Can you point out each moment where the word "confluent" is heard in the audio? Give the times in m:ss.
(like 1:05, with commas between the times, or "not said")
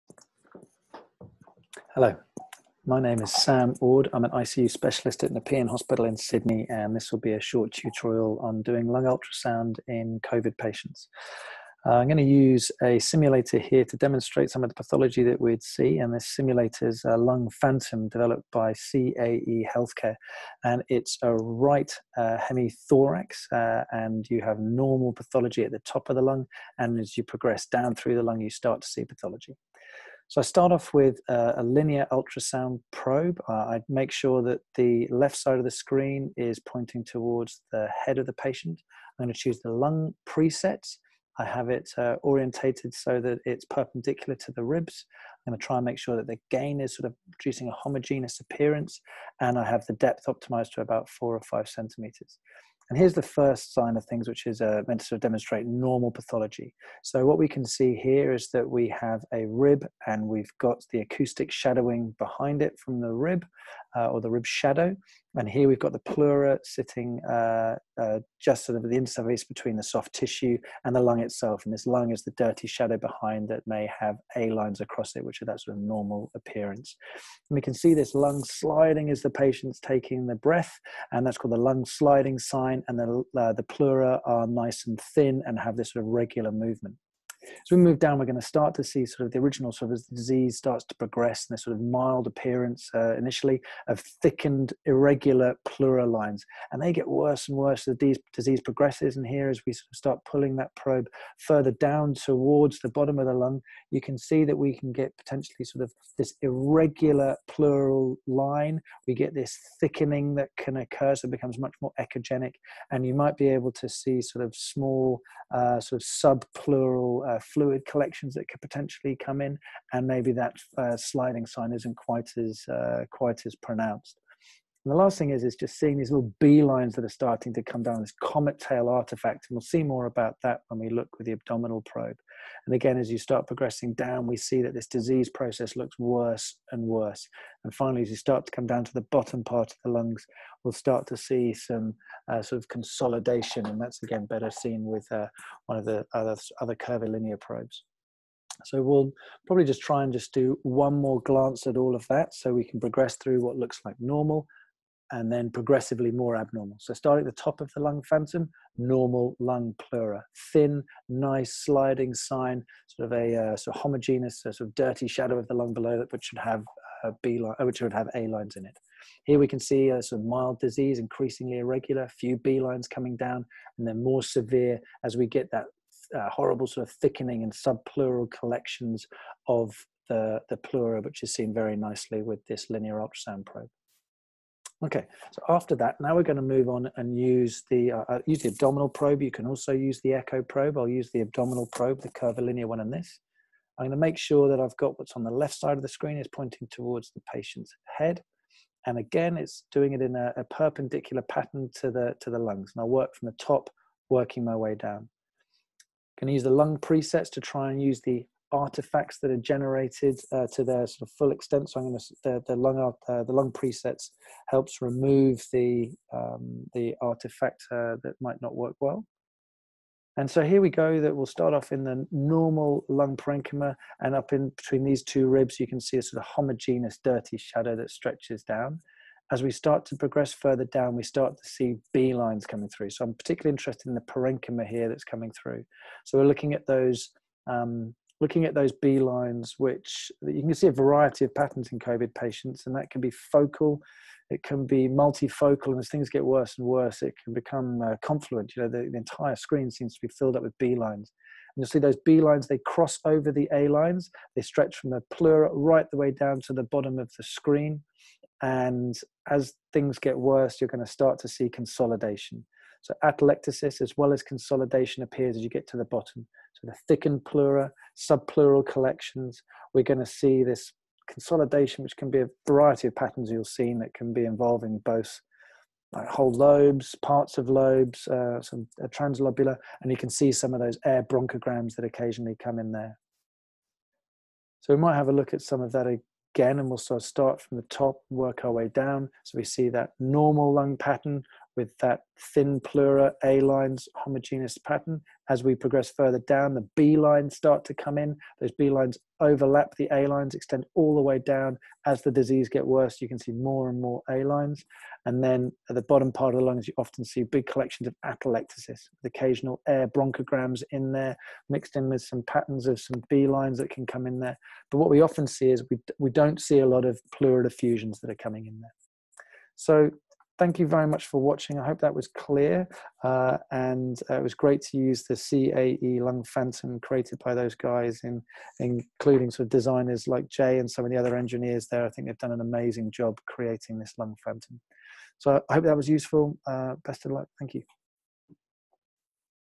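4:08.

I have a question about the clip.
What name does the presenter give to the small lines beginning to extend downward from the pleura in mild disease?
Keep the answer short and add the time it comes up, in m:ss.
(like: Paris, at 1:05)
comet tail artifact, at 2:08.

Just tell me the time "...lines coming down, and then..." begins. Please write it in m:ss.
2:52.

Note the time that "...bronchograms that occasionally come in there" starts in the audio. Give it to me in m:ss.
4:41.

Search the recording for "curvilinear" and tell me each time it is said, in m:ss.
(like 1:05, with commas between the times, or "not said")
2:26, 3:12.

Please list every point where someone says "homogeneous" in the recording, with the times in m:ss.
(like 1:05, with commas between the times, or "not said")
0:47, 2:43, 3:46, 4:53.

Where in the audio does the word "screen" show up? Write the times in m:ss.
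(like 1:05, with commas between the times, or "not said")
0:35, 3:15, 4:09, 4:17.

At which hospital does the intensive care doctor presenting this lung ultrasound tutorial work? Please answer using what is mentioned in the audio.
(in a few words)
Nepean Hospital.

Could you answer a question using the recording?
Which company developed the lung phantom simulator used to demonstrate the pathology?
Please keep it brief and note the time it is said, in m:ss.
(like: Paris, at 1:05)
CAE Healthcare, at 0:18.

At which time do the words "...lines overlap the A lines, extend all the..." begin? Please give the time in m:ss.
4:58.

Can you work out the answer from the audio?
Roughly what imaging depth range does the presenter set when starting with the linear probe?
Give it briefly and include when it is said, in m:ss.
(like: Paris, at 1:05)
4 or 5 centimeters, at 0:51.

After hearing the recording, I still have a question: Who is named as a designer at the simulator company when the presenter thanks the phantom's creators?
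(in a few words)
Jay.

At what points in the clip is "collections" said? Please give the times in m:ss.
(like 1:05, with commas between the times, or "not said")
1:57, 2:58, 4:28, 5:07.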